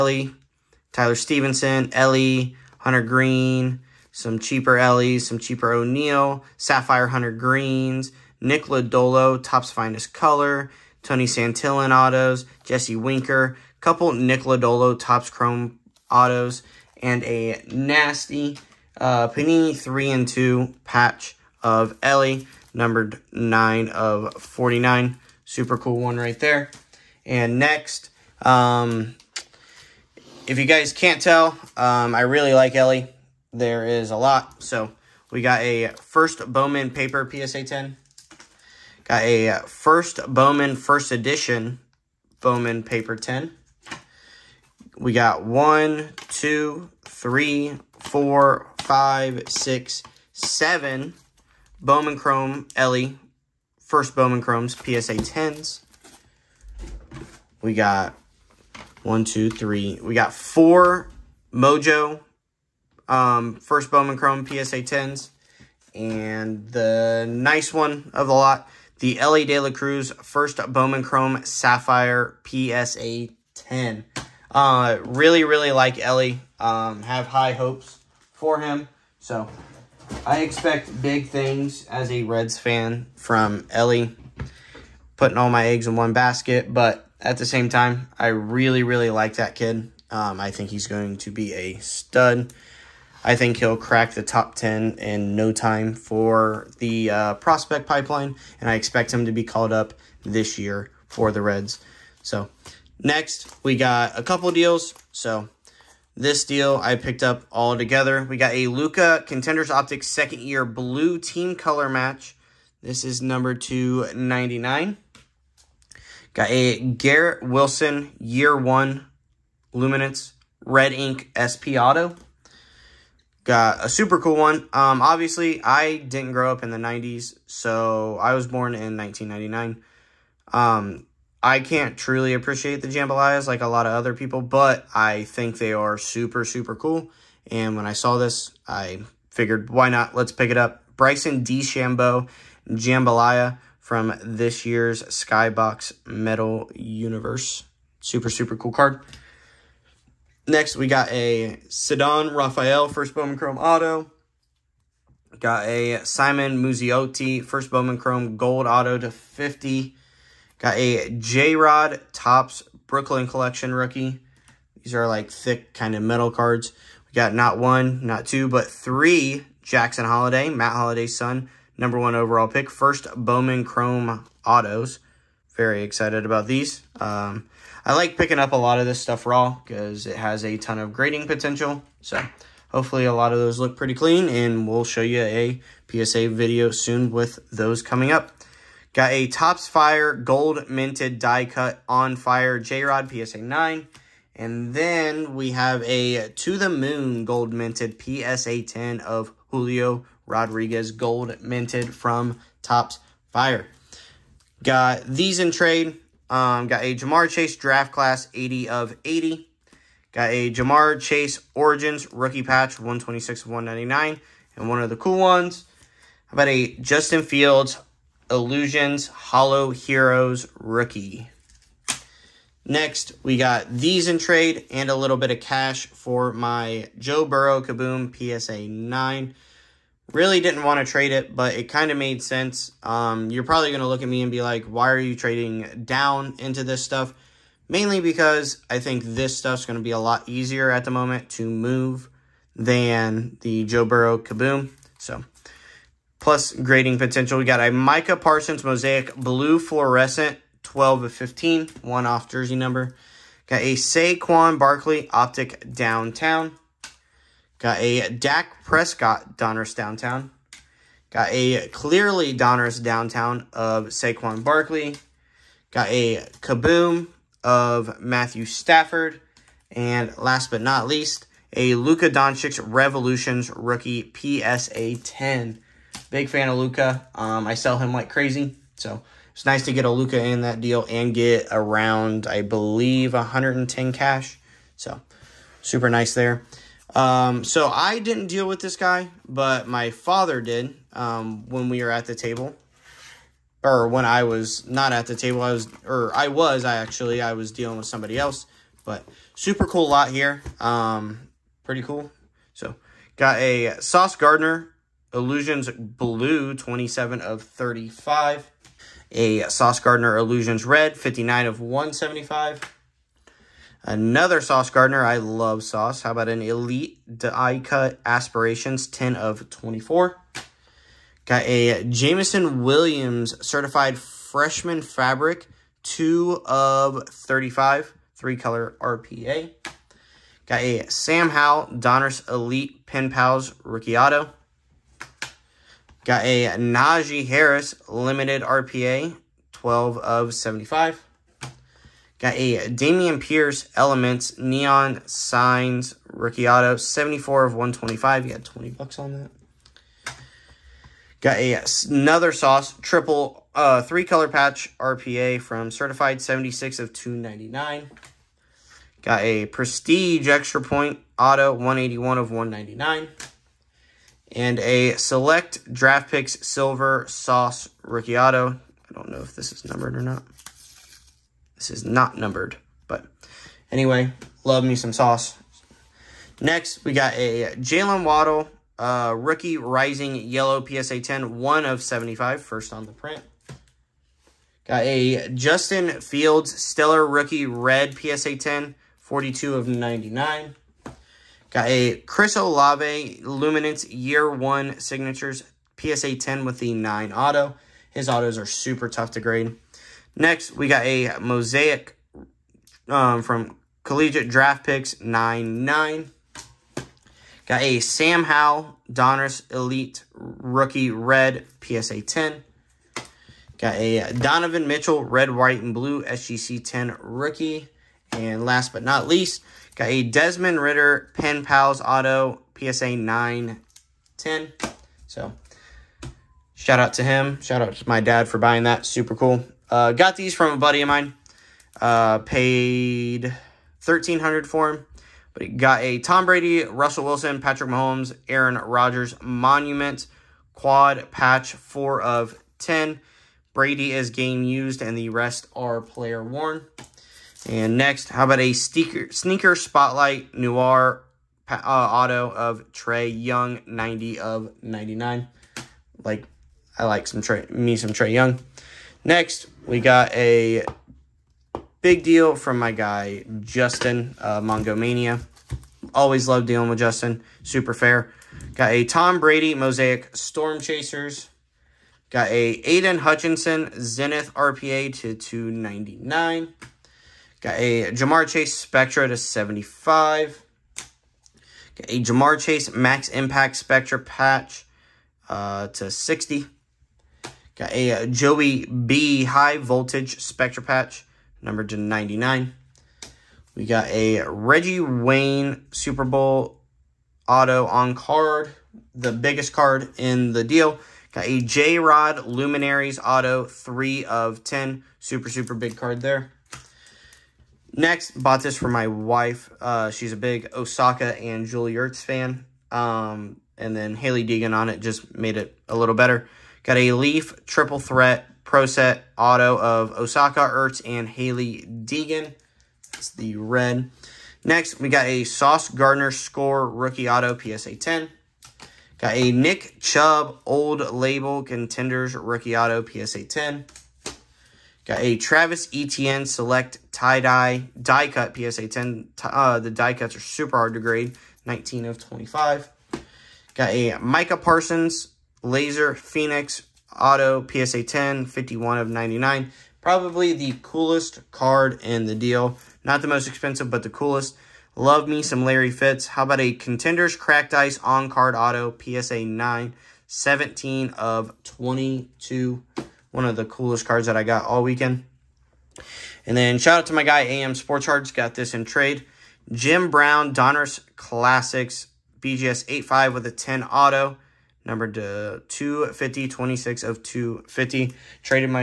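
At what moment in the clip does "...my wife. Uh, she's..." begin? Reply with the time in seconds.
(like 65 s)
508 s.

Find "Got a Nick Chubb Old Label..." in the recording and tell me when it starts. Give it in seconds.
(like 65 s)
528 s.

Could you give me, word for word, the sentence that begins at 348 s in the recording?
You got 20 bucks on that.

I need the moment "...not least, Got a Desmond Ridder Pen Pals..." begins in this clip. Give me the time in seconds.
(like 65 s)
418 s.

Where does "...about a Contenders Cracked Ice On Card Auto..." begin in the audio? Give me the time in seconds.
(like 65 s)
556 s.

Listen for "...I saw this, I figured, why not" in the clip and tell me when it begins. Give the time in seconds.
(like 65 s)
137 s.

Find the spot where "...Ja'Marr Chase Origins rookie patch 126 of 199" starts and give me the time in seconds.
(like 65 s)
210 s.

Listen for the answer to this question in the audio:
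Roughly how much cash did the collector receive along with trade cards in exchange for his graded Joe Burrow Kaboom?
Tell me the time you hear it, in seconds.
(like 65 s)
283 s.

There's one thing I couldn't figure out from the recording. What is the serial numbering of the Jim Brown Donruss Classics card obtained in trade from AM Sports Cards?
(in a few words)
26 of 250.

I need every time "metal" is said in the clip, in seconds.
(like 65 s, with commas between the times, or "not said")
146 s, 166 s.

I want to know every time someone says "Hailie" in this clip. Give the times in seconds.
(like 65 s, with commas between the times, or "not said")
513 s, 521 s.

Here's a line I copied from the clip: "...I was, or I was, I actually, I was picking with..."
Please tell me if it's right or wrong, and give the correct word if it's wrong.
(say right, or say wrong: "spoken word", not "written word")
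wrong: "dealing", not "picking".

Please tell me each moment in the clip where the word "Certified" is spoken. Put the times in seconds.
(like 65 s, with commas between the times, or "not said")
323 s, 355 s.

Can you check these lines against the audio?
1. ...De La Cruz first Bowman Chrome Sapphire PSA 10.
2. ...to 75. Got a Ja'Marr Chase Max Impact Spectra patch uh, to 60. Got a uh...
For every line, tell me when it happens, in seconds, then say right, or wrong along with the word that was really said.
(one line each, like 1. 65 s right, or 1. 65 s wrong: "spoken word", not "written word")
1. 69 s right
2. 479 s right.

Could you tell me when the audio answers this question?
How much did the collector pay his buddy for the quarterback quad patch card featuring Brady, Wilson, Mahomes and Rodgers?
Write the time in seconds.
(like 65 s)
433 s.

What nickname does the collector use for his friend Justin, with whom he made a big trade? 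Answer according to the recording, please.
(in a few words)
Mongomania.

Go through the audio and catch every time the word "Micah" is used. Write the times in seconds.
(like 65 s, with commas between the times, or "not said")
247 s, 543 s.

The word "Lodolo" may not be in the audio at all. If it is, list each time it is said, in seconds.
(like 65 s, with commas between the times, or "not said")
8 s, 14 s.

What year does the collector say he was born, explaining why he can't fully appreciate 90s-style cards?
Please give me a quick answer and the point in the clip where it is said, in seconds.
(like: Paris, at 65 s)
1999, at 128 s.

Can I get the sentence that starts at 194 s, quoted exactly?
And then we have a To the Moon gold minted PSA 10 of Julio Rodriguez gold minted from Topps Fire.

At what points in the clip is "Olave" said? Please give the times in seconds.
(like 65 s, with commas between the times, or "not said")
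392 s.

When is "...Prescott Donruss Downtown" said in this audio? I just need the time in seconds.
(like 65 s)
258 s.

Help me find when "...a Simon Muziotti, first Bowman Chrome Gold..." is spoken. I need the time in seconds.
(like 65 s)
155 s.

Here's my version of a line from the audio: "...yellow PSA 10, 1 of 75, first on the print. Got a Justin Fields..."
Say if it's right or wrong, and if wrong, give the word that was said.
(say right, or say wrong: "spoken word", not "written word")
right.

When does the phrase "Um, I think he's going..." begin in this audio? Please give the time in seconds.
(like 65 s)
90 s.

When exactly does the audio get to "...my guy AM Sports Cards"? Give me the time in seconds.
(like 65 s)
566 s.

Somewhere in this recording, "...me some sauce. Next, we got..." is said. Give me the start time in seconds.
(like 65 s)
374 s.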